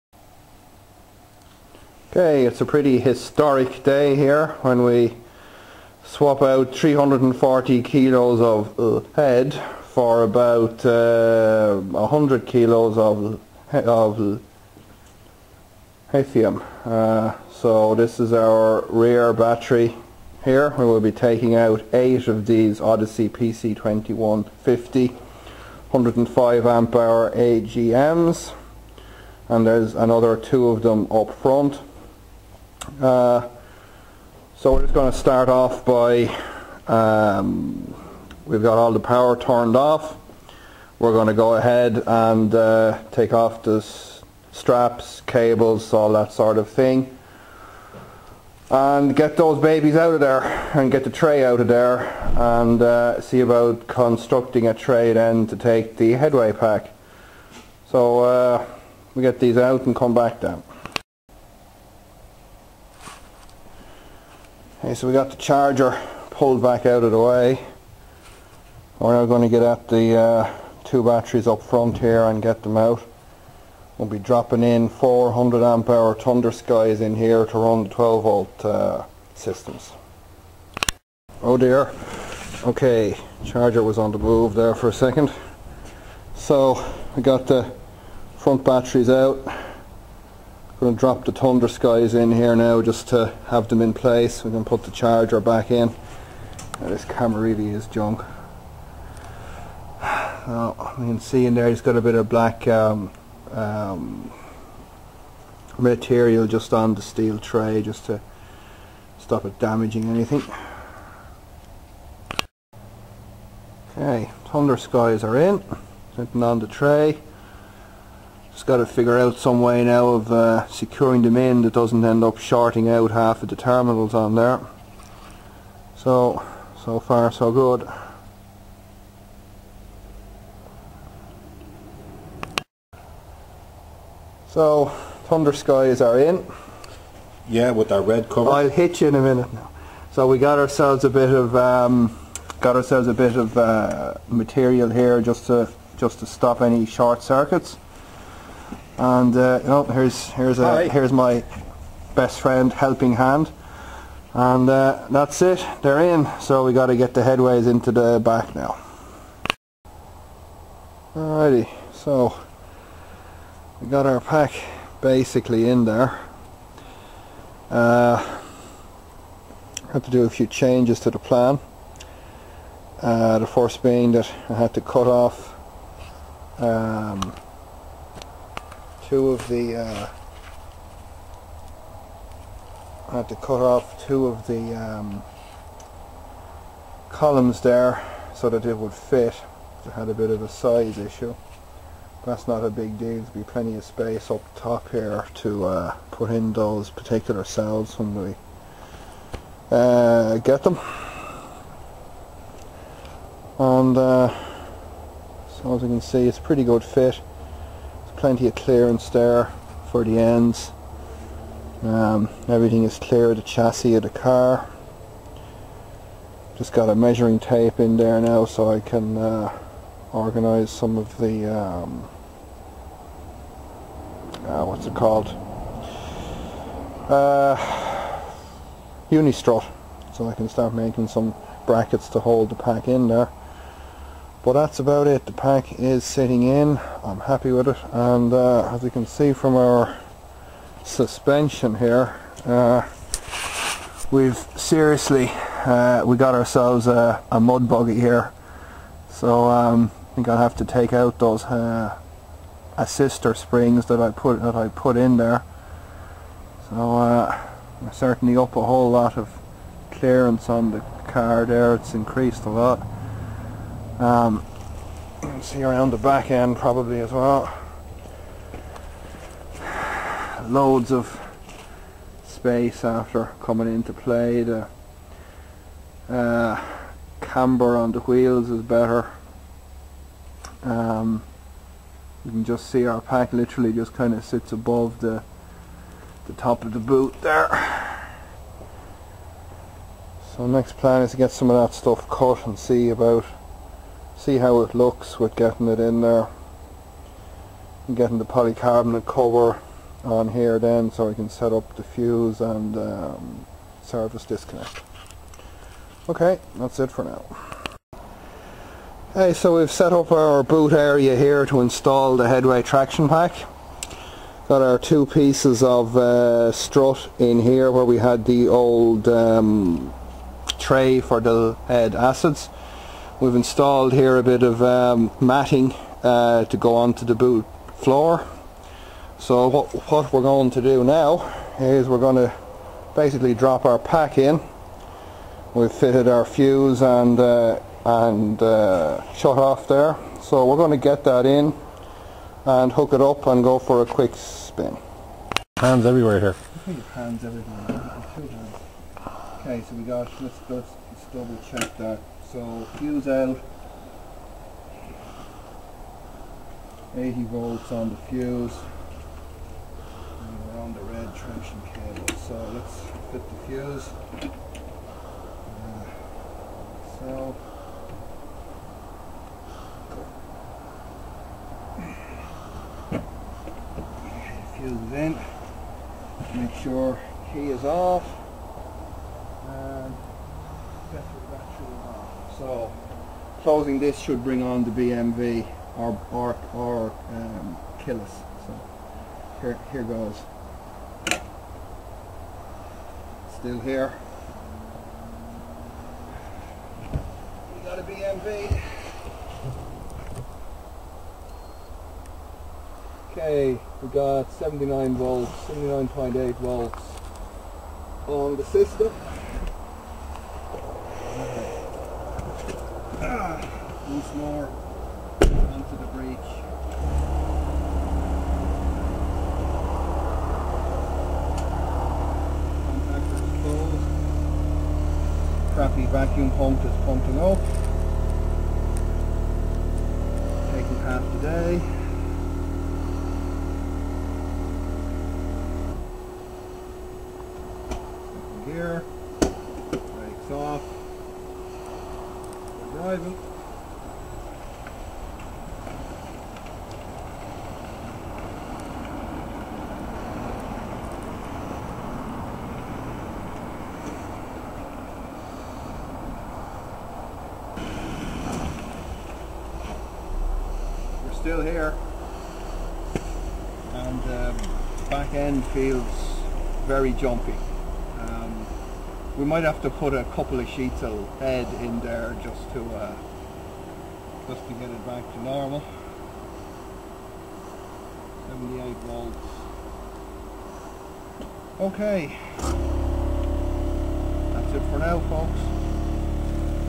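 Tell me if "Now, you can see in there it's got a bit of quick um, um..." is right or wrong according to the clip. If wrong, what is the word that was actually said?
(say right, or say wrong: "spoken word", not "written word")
wrong: "black", not "quick".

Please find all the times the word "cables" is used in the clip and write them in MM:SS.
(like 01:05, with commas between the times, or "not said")
00:45, 06:01.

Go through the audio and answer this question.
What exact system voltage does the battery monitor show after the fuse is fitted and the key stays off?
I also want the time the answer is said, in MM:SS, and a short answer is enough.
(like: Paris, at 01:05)
79.8 volts, at 06:45.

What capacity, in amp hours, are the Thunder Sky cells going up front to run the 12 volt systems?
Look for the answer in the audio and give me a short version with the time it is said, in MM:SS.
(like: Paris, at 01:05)
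400 amp hour, at 01:14.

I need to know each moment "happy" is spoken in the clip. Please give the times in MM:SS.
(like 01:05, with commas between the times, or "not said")
03:57.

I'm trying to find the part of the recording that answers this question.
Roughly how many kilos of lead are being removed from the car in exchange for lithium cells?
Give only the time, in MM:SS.
00:06.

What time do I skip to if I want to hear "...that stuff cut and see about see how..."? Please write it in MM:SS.
04:51.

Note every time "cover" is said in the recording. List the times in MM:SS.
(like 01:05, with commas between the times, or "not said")
02:18, 04:59.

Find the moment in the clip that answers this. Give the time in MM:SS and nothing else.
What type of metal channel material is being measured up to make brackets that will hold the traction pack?
03:49.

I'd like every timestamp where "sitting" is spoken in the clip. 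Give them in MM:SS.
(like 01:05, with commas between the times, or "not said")
01:56, 03:56.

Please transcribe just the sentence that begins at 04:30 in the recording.
Loads of space after coming into play.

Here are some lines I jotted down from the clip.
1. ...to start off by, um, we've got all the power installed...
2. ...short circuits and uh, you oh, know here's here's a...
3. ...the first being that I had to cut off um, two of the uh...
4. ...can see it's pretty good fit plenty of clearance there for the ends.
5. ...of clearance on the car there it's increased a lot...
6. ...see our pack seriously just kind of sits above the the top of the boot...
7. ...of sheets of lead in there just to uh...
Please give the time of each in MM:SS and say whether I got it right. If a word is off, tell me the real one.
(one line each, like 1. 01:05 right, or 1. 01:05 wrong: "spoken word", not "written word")
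1. 00:35 wrong: "turned", not "installed"
2. 02:26 right
3. 02:53 right
4. 03:25 right
5. 04:19 right
6. 04:42 wrong: "literally", not "seriously"
7. 07:50 right.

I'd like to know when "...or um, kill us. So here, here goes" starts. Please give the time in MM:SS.
06:26.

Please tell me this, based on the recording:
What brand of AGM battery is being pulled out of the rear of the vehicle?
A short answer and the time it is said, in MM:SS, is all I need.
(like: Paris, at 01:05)
Odyssey, at 00:22.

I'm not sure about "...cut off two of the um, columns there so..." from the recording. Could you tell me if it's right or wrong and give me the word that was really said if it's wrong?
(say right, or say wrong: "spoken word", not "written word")
right.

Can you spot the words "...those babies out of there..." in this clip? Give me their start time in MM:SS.
00:49.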